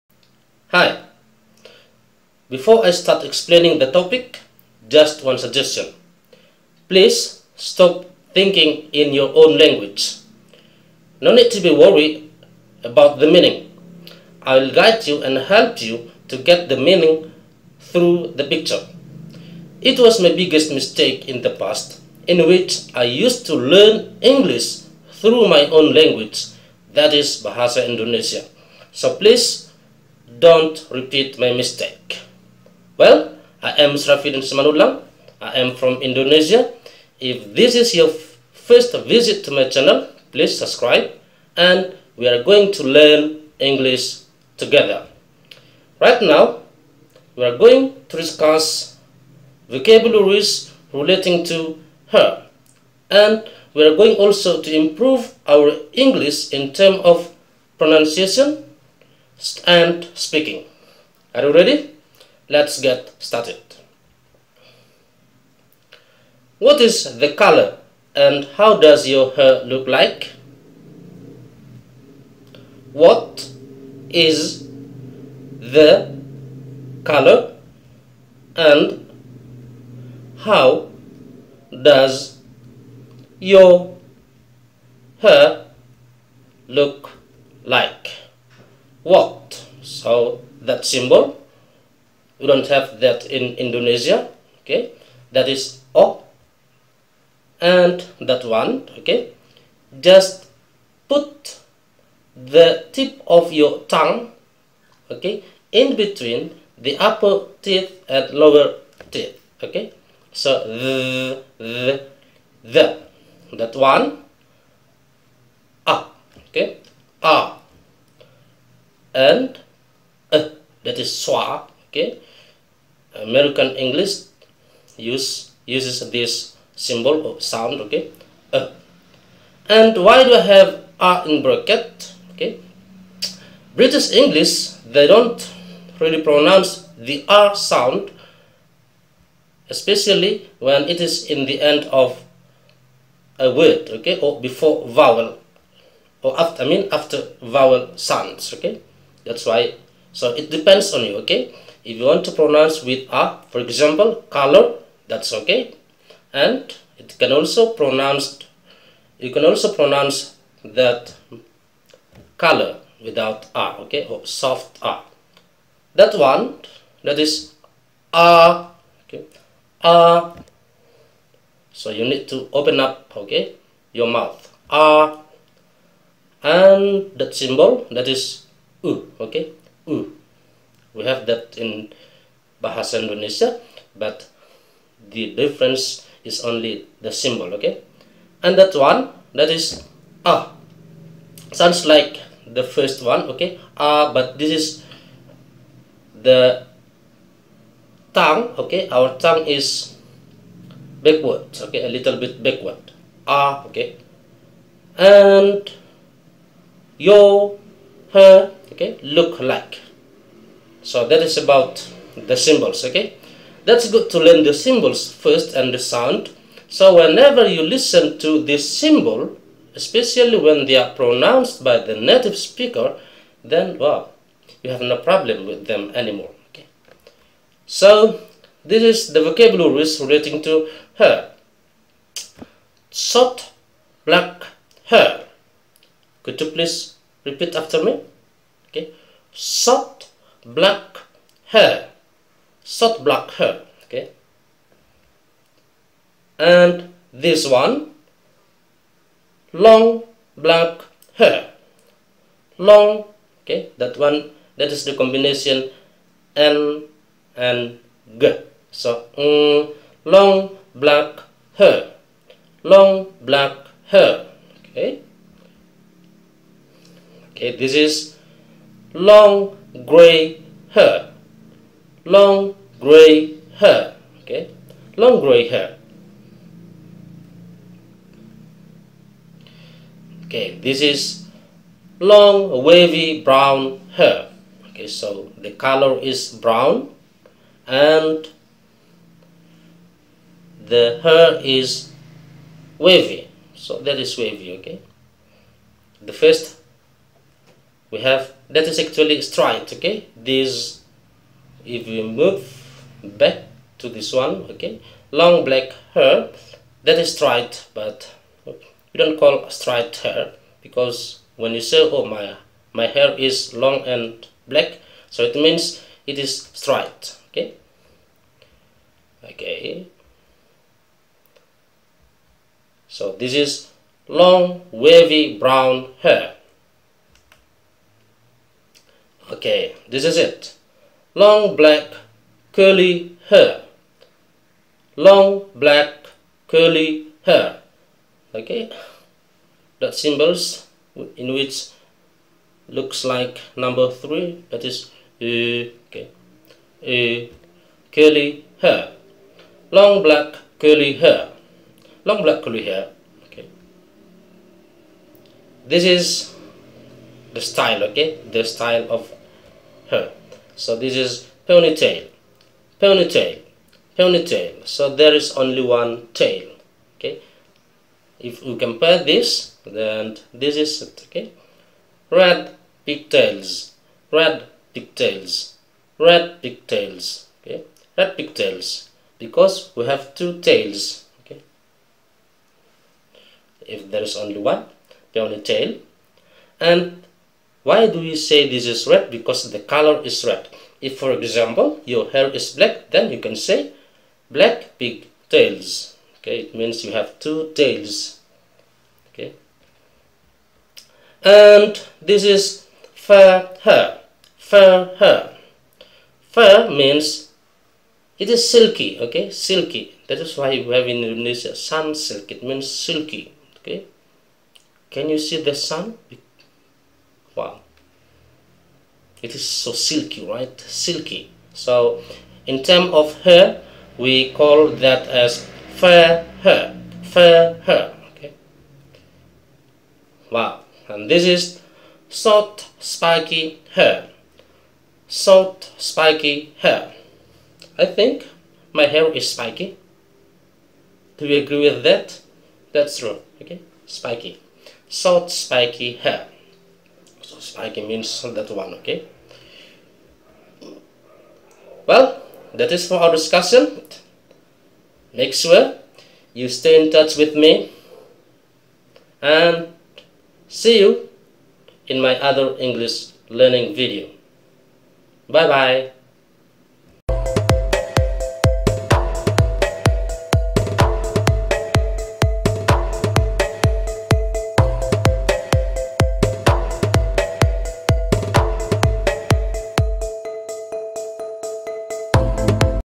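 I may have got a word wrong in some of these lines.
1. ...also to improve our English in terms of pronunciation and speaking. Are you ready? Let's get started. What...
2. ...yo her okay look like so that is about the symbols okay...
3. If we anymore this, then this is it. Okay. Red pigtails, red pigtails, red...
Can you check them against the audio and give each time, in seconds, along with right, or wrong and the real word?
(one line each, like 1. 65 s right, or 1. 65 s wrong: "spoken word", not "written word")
1. 54 s right
2. 207 s right
3. 368 s wrong: "compare", not "anymore".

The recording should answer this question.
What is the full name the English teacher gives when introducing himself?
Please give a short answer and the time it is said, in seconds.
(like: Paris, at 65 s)
Srafidin Simanullah, at 33 s.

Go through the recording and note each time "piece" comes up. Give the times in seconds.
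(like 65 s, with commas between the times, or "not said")
not said.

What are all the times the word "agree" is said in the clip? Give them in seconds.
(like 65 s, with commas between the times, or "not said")
441 s.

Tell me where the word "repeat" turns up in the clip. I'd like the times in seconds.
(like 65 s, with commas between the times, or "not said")
30 s, 237 s.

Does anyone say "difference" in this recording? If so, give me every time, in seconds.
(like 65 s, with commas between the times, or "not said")
185 s.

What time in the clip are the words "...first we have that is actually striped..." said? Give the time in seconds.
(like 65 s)
296 s.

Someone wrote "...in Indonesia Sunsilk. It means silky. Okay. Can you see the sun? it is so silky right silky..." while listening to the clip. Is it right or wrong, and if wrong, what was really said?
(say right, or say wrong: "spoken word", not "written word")
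right.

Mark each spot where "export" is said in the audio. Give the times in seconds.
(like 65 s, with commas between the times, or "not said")
not said.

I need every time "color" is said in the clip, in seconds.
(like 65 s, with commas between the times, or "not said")
67 s, 77 s, 154 s, 162 s, 285 s, 389 s.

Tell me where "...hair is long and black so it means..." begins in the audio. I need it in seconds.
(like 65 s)
312 s.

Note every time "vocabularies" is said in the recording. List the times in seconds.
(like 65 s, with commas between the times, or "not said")
49 s, 229 s.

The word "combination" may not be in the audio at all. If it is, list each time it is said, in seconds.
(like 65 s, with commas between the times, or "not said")
254 s.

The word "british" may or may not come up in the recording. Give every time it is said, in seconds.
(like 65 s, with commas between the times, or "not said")
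133 s.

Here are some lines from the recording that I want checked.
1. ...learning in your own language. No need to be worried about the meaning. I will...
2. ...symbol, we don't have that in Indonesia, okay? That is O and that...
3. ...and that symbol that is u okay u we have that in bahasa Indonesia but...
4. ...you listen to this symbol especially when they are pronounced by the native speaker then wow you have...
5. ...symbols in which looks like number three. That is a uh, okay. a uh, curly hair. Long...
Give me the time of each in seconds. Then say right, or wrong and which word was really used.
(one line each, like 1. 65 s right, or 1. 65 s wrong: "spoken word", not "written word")
1. 8 s wrong: "thinking", not "learning"
2. 90 s right
3. 176 s right
4. 217 s right
5. 339 s right.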